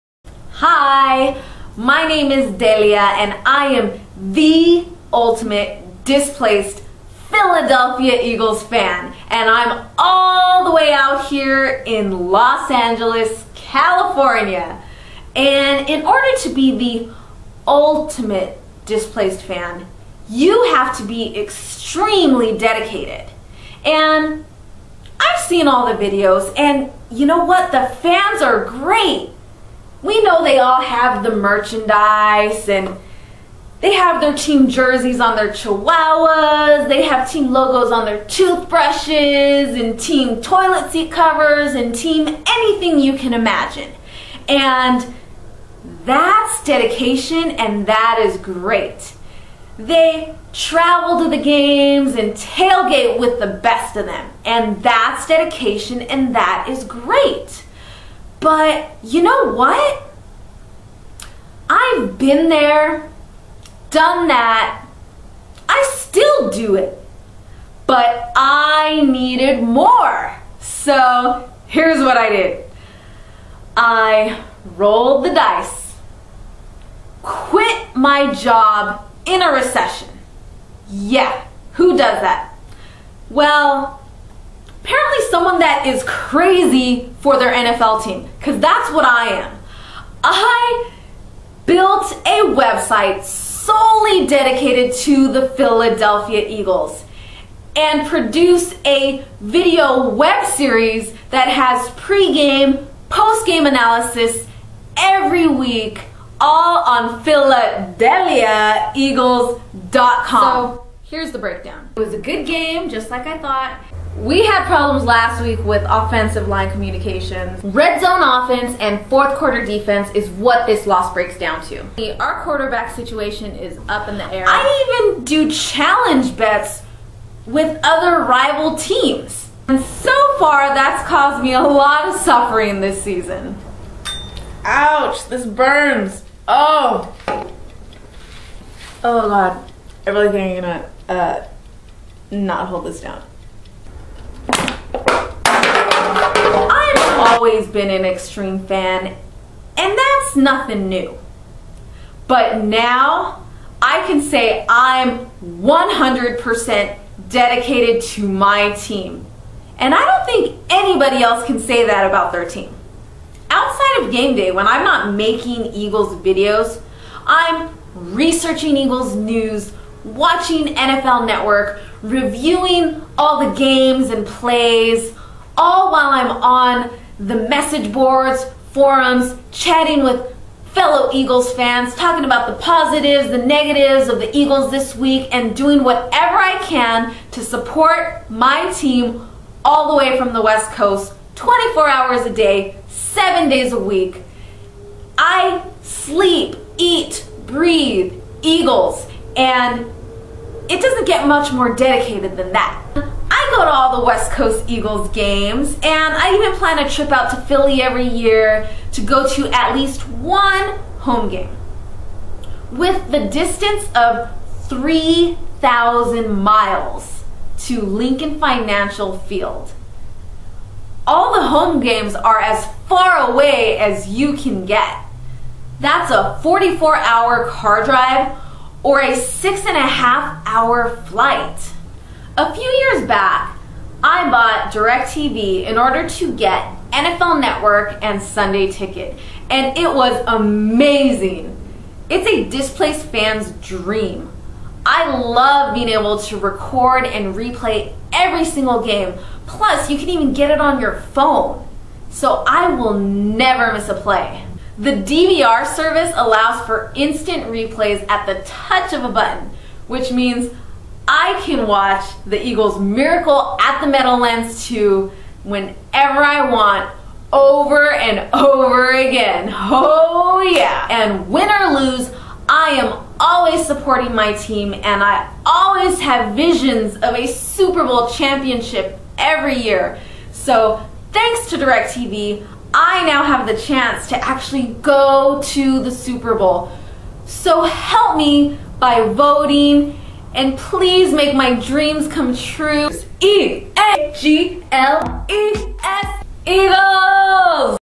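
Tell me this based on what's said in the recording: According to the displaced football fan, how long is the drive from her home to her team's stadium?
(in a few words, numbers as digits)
44 hours.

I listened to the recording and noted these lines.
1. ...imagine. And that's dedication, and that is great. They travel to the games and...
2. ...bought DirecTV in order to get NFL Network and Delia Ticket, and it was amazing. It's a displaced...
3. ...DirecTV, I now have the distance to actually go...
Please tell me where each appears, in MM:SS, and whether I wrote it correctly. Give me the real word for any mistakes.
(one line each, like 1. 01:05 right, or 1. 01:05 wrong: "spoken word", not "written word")
1. 00:43 right
2. 03:54 wrong: "Sunday", not "Delia"
3. 04:41 wrong: "chance", not "distance".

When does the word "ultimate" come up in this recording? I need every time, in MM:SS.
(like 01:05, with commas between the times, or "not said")
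00:05, 00:17.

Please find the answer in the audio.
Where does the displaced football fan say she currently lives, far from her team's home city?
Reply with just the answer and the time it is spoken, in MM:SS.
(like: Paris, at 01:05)
Los Angeles, at 00:12.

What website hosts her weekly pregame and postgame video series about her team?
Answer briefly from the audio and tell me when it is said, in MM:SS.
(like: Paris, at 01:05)
PhiladelphiaEagles.com, at 01:47.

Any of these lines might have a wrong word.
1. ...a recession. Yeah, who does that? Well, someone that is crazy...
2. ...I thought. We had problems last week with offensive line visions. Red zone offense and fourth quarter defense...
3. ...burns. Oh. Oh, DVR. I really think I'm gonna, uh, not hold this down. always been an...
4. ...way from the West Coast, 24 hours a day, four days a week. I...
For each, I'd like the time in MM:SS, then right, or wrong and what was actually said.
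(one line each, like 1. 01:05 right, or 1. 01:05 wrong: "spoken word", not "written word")
1. 01:19 right
2. 01:53 wrong: "communications", not "visions"
3. 02:15 wrong: "God", not "DVR"
4. 03:09 wrong: "seven", not "four".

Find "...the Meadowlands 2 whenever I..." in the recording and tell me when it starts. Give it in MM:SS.
04:23.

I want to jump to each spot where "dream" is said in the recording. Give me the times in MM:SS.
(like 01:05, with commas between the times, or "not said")
04:03, 04:51.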